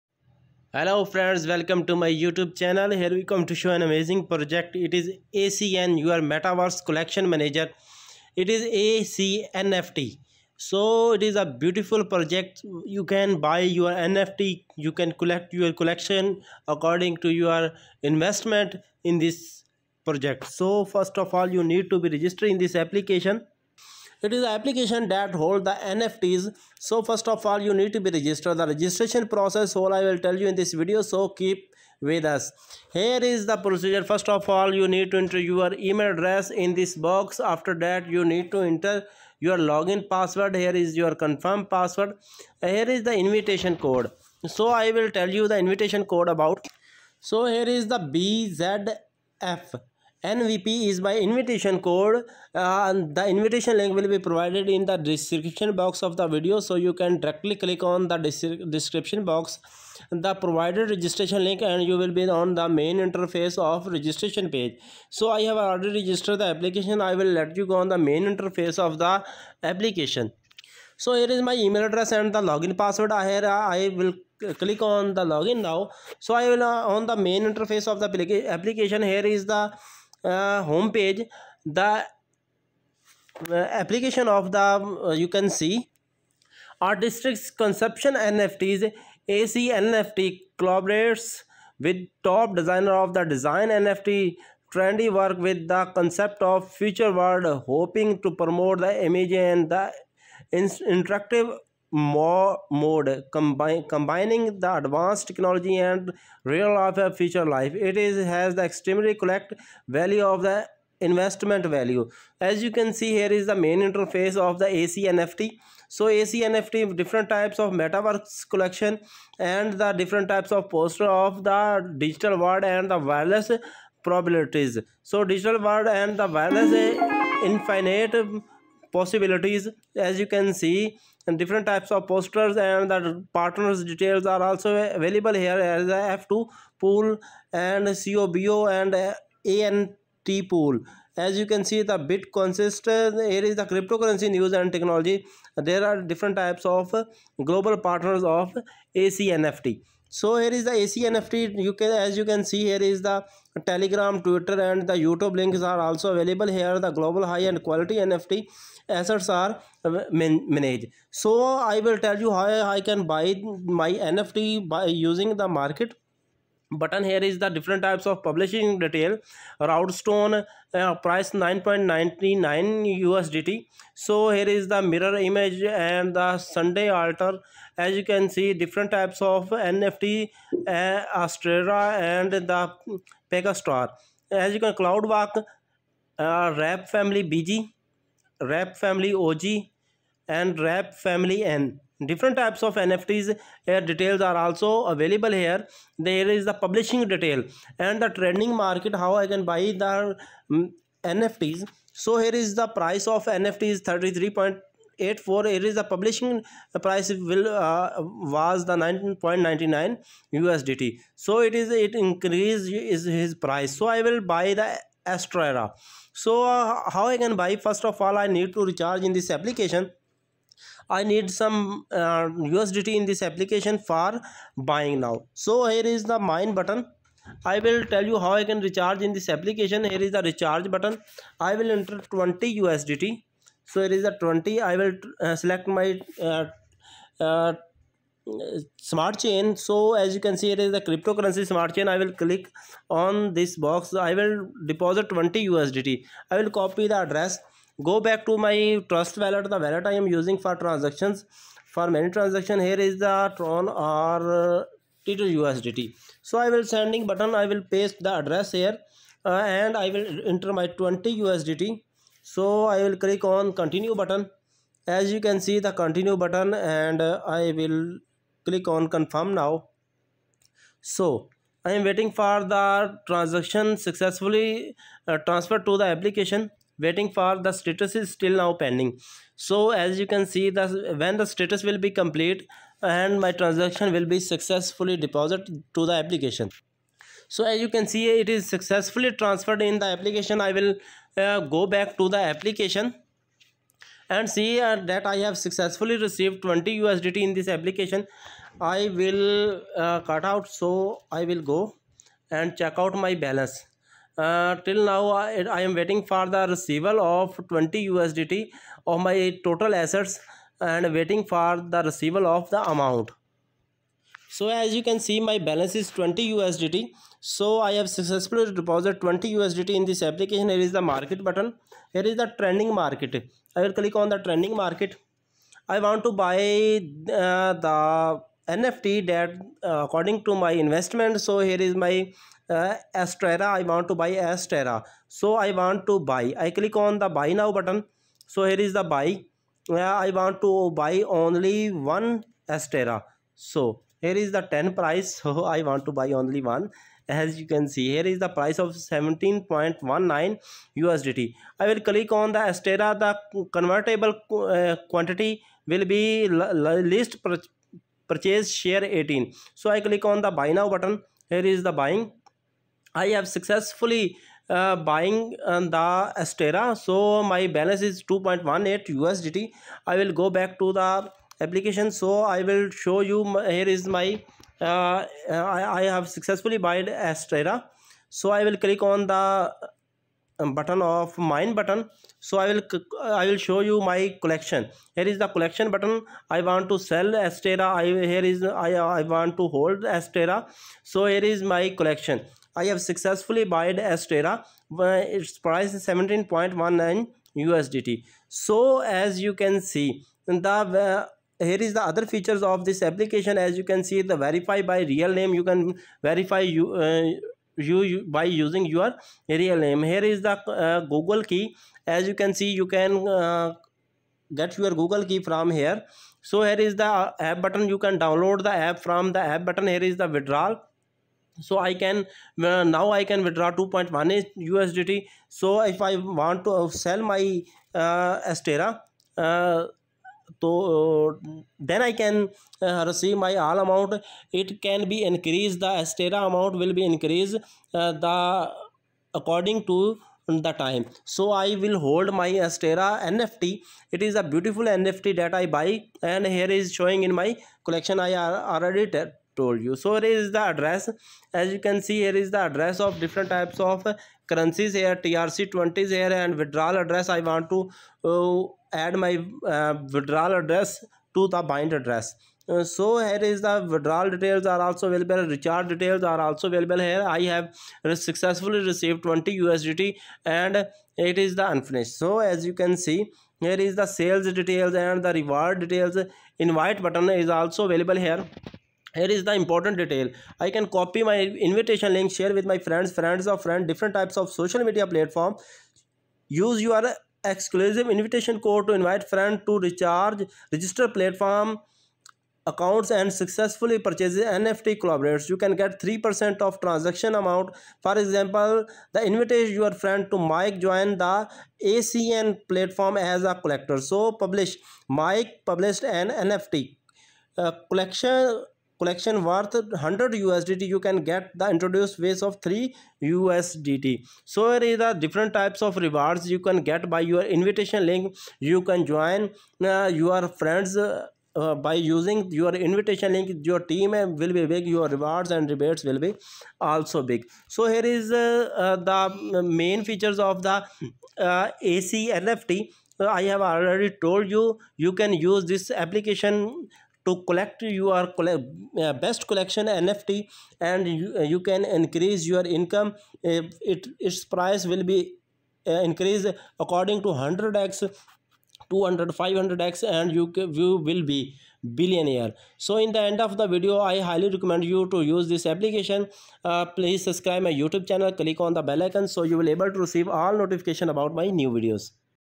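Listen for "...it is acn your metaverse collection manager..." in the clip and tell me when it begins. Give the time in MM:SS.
00:04.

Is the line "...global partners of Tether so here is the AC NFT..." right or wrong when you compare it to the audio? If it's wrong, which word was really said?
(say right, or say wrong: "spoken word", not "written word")
wrong: "ACNFT", not "Tether".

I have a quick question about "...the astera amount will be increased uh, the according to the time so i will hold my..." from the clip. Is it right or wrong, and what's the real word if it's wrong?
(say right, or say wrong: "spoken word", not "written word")
right.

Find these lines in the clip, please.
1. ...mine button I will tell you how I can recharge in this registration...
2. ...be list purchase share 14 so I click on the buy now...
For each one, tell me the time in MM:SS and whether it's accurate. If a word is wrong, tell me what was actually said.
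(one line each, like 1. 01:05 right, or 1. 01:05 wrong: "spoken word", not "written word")
1. 03:46 wrong: "application", not "registration"
2. 05:55 wrong: "18", not "14".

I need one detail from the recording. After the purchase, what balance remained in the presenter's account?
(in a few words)
2.18 USDT.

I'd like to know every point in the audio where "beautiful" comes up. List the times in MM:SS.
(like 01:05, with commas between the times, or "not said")
00:11, 07:24.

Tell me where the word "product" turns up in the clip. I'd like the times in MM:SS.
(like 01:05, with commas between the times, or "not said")
not said.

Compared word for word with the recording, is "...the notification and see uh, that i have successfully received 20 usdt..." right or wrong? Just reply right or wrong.
wrong.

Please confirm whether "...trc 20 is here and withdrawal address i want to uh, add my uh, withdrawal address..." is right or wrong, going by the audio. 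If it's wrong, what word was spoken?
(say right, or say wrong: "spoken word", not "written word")
right.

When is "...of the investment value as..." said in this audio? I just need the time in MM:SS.
01:50.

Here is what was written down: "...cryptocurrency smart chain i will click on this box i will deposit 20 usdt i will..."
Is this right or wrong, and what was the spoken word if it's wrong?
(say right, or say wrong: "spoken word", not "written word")
right.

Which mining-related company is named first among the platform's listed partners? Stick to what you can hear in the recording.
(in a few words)
F2 pool.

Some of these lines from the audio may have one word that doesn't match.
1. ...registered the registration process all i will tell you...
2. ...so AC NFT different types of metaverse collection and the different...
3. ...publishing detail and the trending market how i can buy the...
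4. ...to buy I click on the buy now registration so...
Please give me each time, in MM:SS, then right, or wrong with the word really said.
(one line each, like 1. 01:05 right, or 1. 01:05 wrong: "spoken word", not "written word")
1. 00:28 right
2. 01:55 right
3. 03:16 right
4. 05:35 wrong: "button", not "registration".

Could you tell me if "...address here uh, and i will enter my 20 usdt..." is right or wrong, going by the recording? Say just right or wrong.
right.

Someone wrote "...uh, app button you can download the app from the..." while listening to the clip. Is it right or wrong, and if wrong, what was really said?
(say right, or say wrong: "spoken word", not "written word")
right.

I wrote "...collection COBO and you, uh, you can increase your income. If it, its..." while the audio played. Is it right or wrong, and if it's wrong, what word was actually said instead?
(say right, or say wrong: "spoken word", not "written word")
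wrong: "NFT", not "COBO".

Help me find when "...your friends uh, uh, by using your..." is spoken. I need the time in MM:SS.
08:39.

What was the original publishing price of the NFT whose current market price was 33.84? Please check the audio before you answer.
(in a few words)
19.99 USDT.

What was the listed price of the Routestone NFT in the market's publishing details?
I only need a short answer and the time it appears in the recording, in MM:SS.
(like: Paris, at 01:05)
9.99 USDT, at 02:51.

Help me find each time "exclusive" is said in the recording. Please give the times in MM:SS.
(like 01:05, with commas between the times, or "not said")
08:07.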